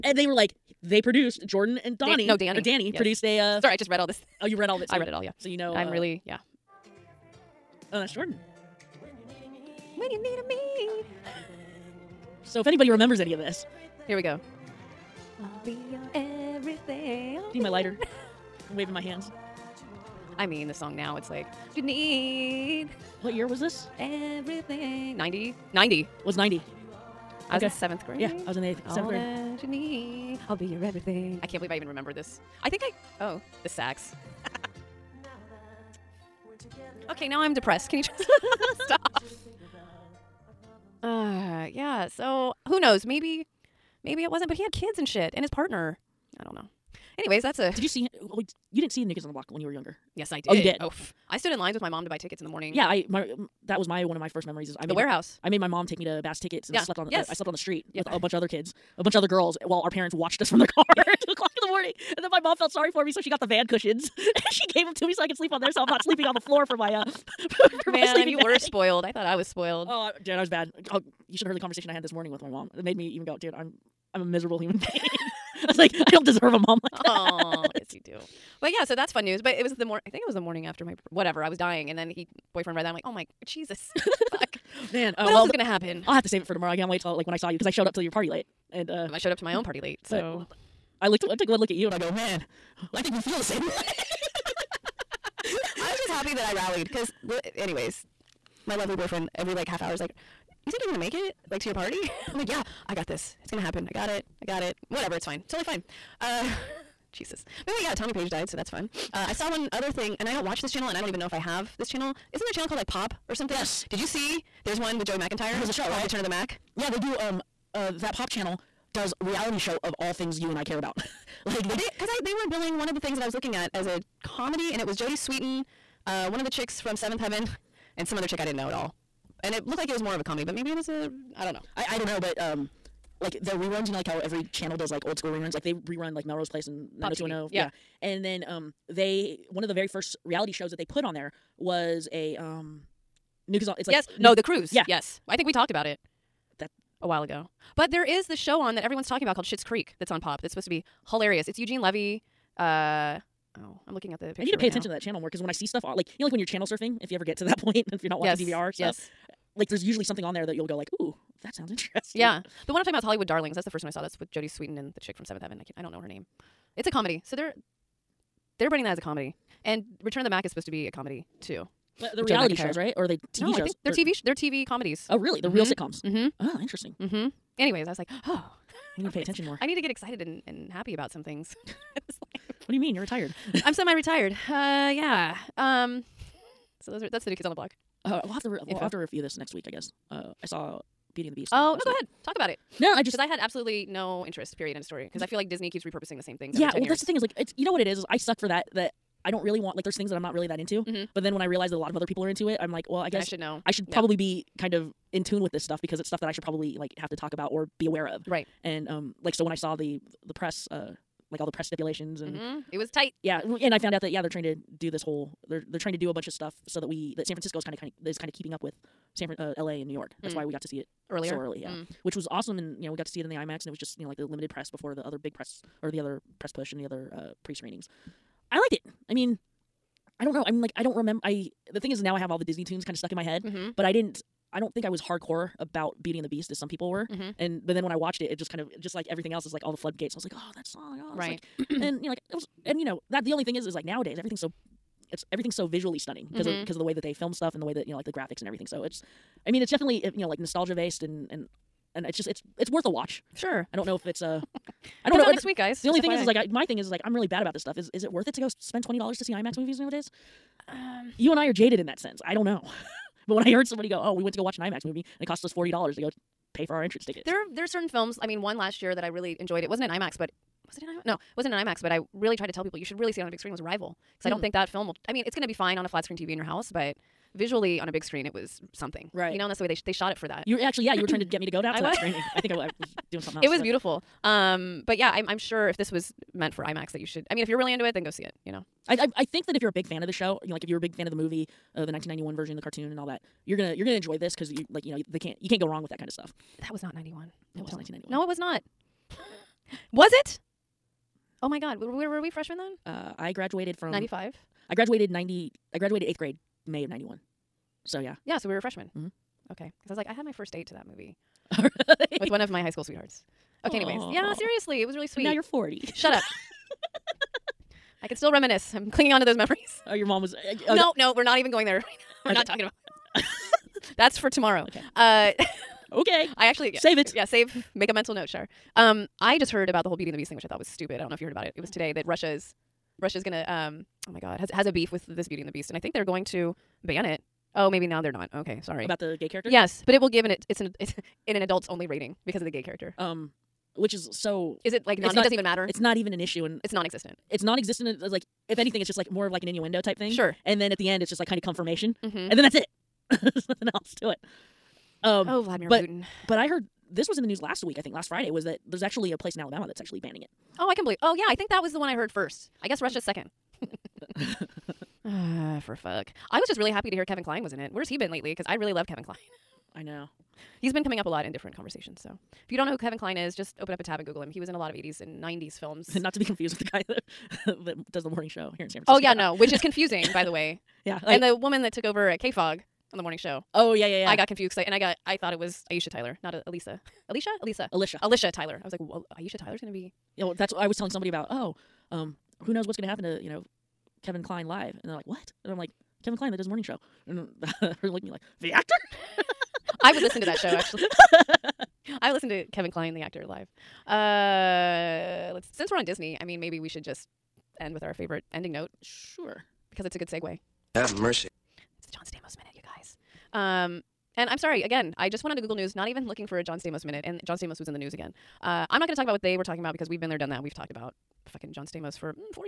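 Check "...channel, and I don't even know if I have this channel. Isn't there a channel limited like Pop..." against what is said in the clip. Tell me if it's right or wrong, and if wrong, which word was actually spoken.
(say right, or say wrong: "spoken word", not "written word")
wrong: "called", not "limited".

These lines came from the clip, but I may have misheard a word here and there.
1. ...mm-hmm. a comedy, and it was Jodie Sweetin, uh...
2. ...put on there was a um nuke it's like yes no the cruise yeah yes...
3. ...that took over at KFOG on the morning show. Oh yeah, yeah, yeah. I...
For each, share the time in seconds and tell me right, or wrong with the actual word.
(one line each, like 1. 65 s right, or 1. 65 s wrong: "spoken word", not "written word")
1. 123 s right
2. 140 s right
3. 381 s right.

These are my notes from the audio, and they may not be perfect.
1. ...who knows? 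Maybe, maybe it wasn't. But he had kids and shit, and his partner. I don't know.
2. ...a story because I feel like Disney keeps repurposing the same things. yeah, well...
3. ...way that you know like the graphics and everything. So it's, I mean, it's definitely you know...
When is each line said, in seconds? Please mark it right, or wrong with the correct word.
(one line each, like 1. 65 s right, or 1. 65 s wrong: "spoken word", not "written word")
1. 42 s right
2. 194 s right
3. 247 s right.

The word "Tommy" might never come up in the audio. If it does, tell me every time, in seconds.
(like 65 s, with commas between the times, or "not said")
107 s.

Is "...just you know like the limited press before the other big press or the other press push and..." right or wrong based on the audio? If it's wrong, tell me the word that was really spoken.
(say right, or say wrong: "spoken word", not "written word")
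right.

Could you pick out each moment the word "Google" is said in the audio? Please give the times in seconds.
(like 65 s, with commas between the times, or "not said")
374 s, 415 s.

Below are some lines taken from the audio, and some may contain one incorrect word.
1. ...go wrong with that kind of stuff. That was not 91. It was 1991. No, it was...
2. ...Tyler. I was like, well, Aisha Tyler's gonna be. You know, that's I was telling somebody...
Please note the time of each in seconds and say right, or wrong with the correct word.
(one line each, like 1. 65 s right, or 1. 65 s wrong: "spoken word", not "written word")
1. 295 s right
2. 388 s right.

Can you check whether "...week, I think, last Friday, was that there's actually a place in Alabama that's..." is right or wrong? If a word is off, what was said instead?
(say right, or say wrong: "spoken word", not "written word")
right.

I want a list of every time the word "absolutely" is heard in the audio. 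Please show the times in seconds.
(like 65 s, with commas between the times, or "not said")
193 s.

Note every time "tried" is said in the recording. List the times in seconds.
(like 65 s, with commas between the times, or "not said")
272 s.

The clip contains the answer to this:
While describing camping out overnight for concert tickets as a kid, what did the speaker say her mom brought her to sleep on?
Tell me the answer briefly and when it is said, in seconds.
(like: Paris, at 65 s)
van cushions, at 63 s.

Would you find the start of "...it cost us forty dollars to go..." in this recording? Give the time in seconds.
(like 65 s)
265 s.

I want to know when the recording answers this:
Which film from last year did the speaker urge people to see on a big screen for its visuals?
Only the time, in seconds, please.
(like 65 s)
273 s.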